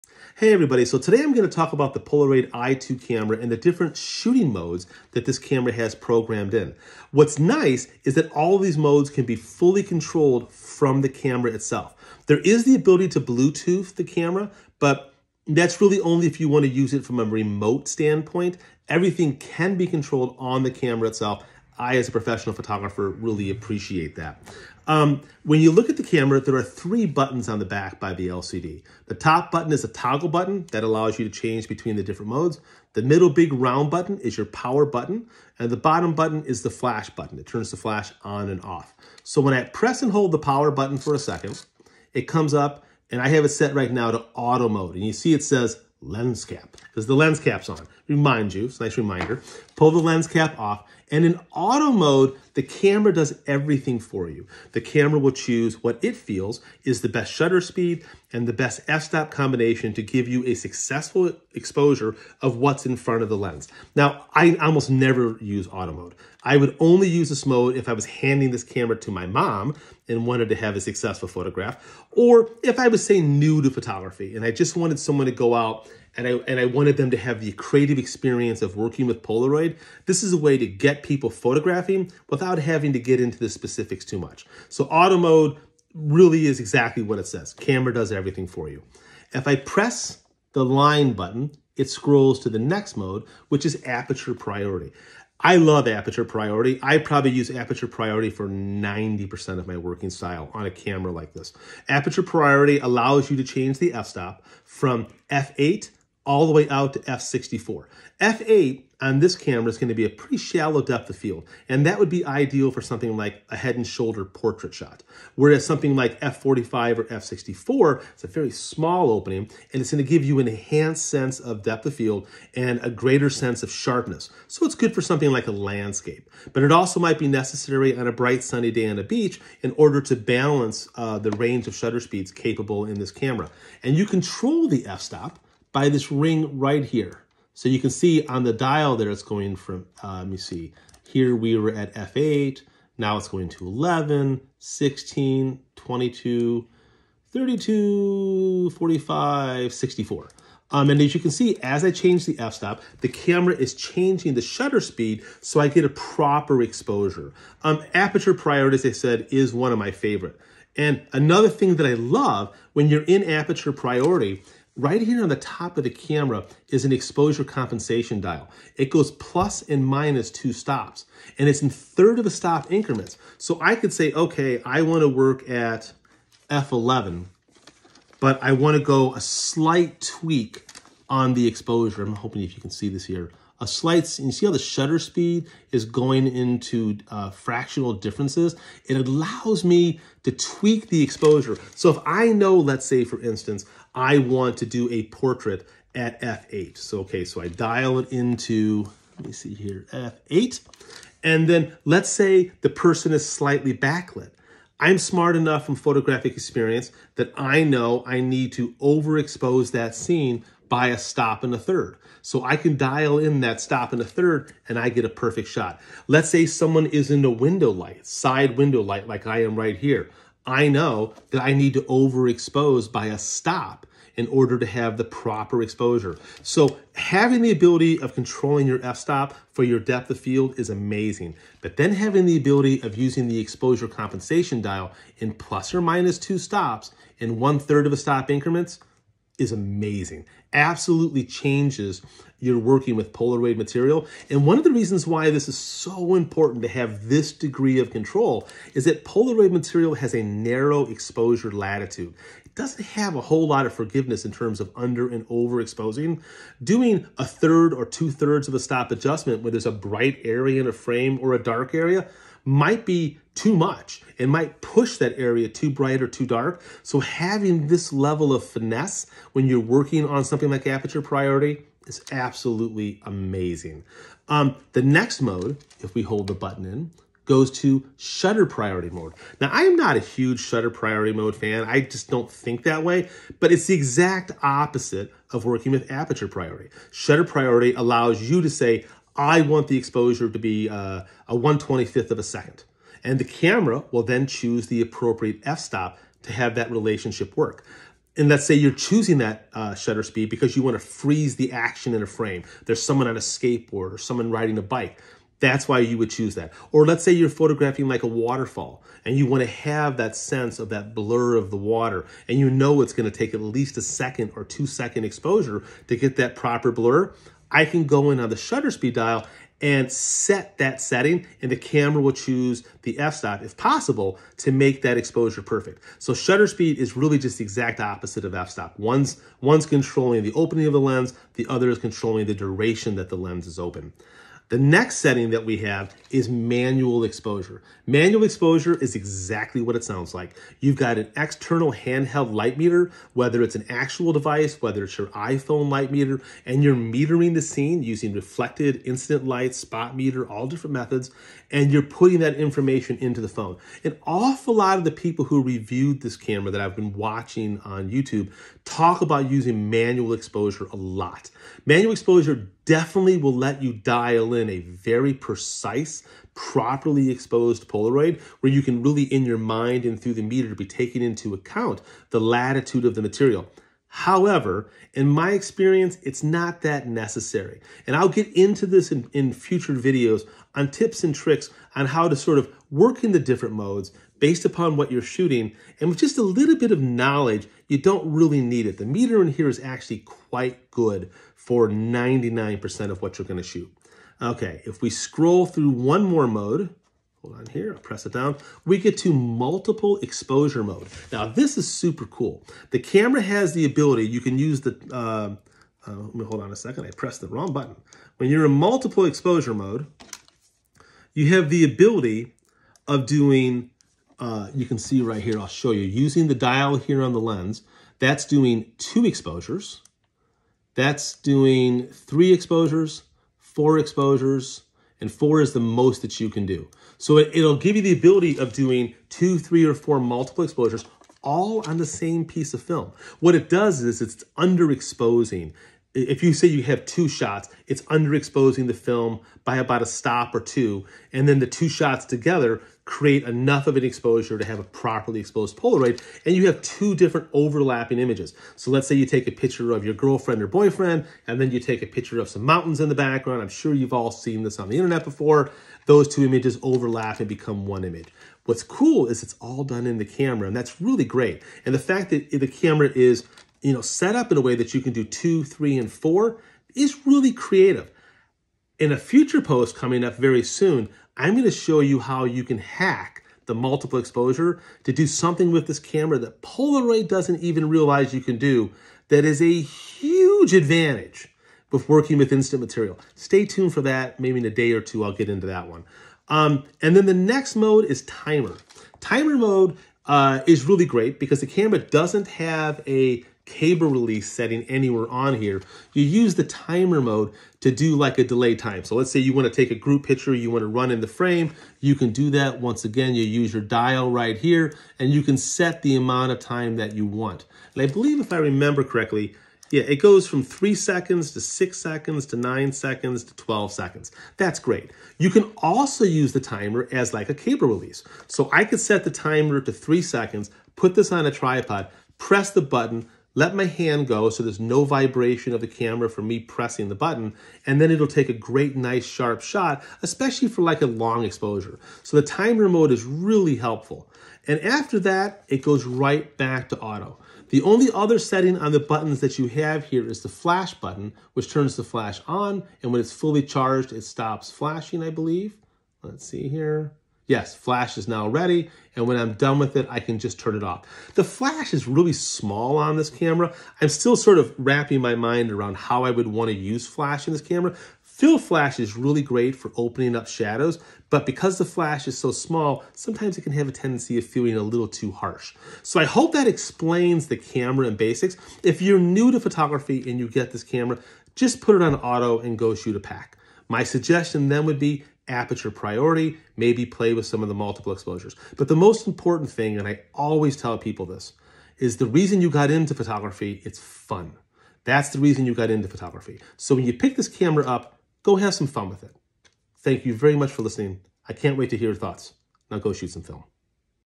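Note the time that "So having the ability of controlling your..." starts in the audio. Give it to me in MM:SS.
03:46.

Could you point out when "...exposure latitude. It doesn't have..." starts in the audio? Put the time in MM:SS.
04:10.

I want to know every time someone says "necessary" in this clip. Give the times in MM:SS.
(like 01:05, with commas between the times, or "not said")
02:07, 06:16.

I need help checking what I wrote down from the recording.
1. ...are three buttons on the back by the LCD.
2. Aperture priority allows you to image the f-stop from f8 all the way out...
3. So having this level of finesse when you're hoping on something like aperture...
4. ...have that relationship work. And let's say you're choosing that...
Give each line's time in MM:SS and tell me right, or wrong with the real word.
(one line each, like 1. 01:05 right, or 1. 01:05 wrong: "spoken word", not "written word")
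1. 00:26 right
2. 01:41 wrong: "change", not "image"
3. 04:26 wrong: "working", not "hoping"
4. 04:56 right.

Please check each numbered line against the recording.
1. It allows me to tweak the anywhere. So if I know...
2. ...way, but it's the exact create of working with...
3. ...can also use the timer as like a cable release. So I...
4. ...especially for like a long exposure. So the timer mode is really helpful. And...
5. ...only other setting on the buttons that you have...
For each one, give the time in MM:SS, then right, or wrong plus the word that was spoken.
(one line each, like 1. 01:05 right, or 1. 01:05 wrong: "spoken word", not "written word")
1. 03:08 wrong: "exposure", not "anywhere"
2. 04:42 wrong: "opposite", not "create"
3. 08:35 right
4. 08:50 right
5. 08:57 right.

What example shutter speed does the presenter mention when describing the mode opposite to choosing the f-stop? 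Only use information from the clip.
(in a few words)
1/125 second.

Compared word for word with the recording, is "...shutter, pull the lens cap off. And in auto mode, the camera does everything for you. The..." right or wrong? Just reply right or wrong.
wrong.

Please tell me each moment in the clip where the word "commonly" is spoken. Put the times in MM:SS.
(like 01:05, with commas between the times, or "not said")
not said.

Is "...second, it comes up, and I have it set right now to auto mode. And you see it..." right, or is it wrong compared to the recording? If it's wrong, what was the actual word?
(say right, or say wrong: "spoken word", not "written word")
right.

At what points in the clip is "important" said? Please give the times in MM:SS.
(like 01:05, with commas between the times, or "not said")
04:06, 09:39.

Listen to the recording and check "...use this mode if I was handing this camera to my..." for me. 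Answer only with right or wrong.
right.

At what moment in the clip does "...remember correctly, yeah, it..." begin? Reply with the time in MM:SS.
08:28.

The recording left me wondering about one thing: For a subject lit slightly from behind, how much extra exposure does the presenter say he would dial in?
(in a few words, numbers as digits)
A stop and a third.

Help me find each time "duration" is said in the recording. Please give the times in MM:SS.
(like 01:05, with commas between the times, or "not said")
05:32.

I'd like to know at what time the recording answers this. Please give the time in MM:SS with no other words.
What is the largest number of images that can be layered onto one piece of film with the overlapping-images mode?
07:05.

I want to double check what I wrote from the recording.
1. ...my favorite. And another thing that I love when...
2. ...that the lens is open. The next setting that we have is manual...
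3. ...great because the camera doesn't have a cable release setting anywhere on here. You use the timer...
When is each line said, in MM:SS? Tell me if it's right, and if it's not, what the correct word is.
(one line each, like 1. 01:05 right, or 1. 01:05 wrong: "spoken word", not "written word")
1. 02:39 right
2. 05:32 right
3. 08:10 right.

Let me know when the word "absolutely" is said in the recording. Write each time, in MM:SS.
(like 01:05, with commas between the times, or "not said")
04:00, 04:32.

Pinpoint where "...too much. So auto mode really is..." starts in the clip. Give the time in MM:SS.
01:24.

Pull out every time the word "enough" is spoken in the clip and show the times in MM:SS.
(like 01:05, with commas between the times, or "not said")
03:25, 07:23.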